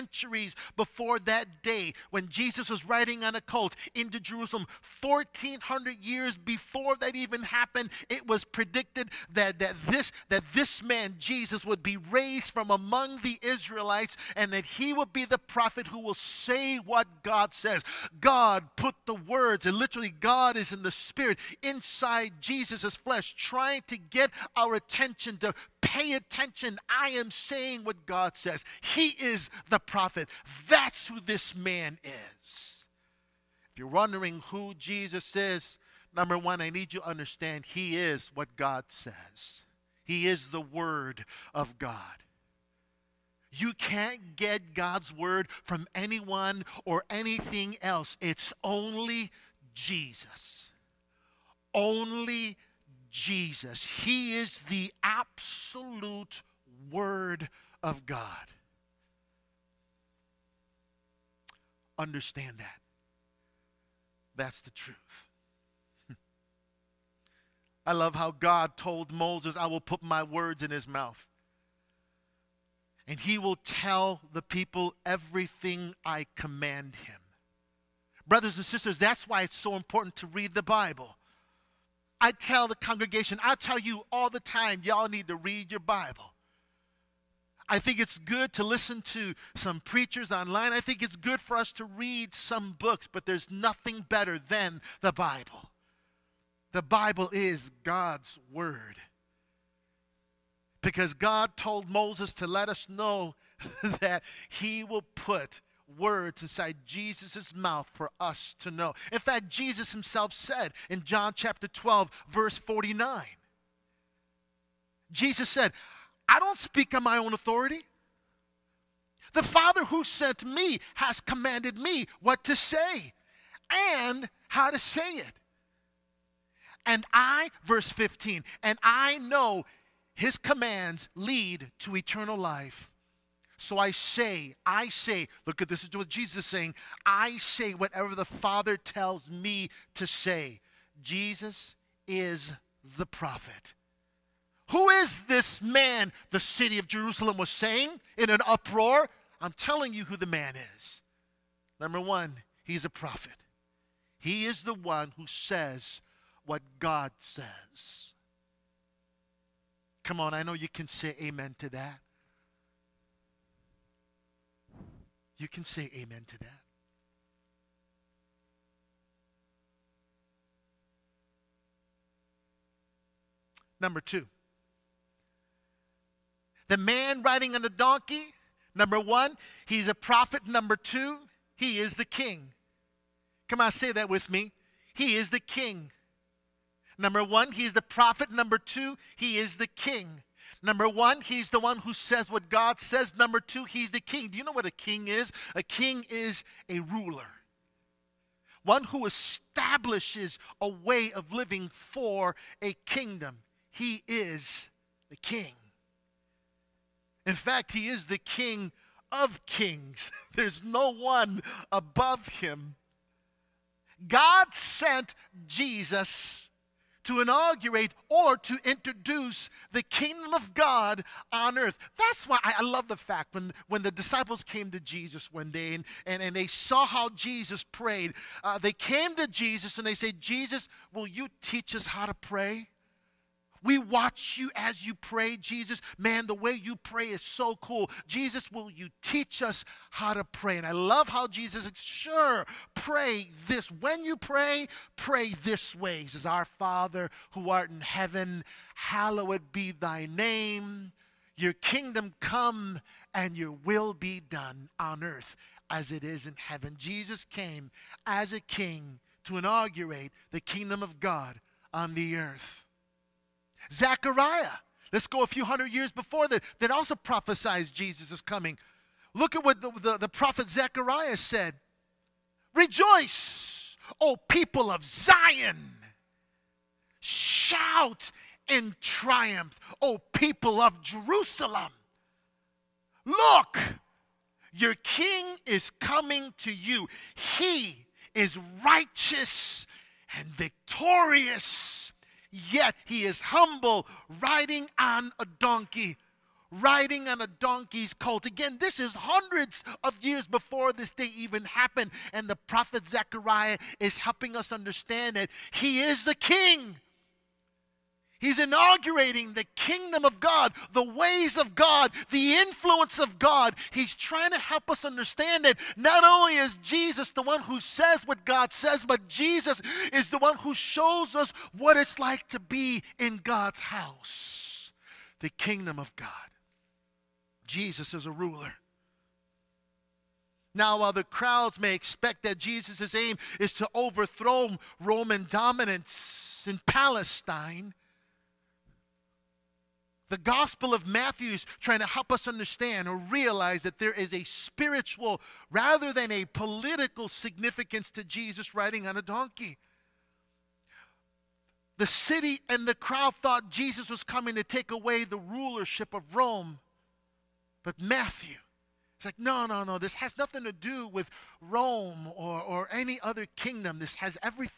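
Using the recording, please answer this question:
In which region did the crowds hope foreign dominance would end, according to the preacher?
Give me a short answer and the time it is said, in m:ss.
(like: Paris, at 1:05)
Palestine, at 5:36.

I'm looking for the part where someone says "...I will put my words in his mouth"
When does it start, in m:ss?
1:09.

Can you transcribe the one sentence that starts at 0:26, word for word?
I am saying what God says says.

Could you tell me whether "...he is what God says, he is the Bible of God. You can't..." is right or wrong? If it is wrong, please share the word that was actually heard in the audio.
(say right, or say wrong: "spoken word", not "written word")
wrong: "Word", not "Bible".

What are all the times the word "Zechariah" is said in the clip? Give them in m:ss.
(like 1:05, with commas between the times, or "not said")
4:23, 4:30, 5:02.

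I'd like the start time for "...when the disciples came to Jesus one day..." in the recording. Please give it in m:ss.
3:43.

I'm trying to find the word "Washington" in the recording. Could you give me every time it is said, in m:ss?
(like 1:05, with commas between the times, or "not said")
not said.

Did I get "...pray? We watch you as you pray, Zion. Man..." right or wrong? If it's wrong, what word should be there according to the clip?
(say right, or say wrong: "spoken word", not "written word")
wrong: "Jesus", not "Zion".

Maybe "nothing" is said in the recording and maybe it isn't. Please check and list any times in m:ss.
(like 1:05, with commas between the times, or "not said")
1:33, 6:00.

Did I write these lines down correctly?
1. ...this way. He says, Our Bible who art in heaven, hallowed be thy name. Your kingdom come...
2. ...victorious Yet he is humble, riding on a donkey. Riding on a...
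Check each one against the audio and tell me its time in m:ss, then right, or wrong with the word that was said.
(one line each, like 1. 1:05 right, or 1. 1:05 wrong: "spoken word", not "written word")
1. 4:05 wrong: "Father", not "Bible"
2. 4:50 right.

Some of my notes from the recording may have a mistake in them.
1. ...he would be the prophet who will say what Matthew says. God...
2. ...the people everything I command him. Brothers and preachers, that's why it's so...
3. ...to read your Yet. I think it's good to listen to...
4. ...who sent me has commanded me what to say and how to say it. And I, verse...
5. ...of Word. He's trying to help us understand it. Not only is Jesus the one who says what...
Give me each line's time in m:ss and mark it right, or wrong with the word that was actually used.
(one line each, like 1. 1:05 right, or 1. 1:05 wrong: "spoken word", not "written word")
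1. 0:14 wrong: "God", not "Matthew"
2. 1:14 wrong: "sisters", not "preachers"
3. 1:25 wrong: "Bible", not "Yet"
4. 1:59 right
5. 5:12 wrong: "God", not "Word".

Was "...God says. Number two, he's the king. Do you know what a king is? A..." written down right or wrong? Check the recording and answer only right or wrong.
right.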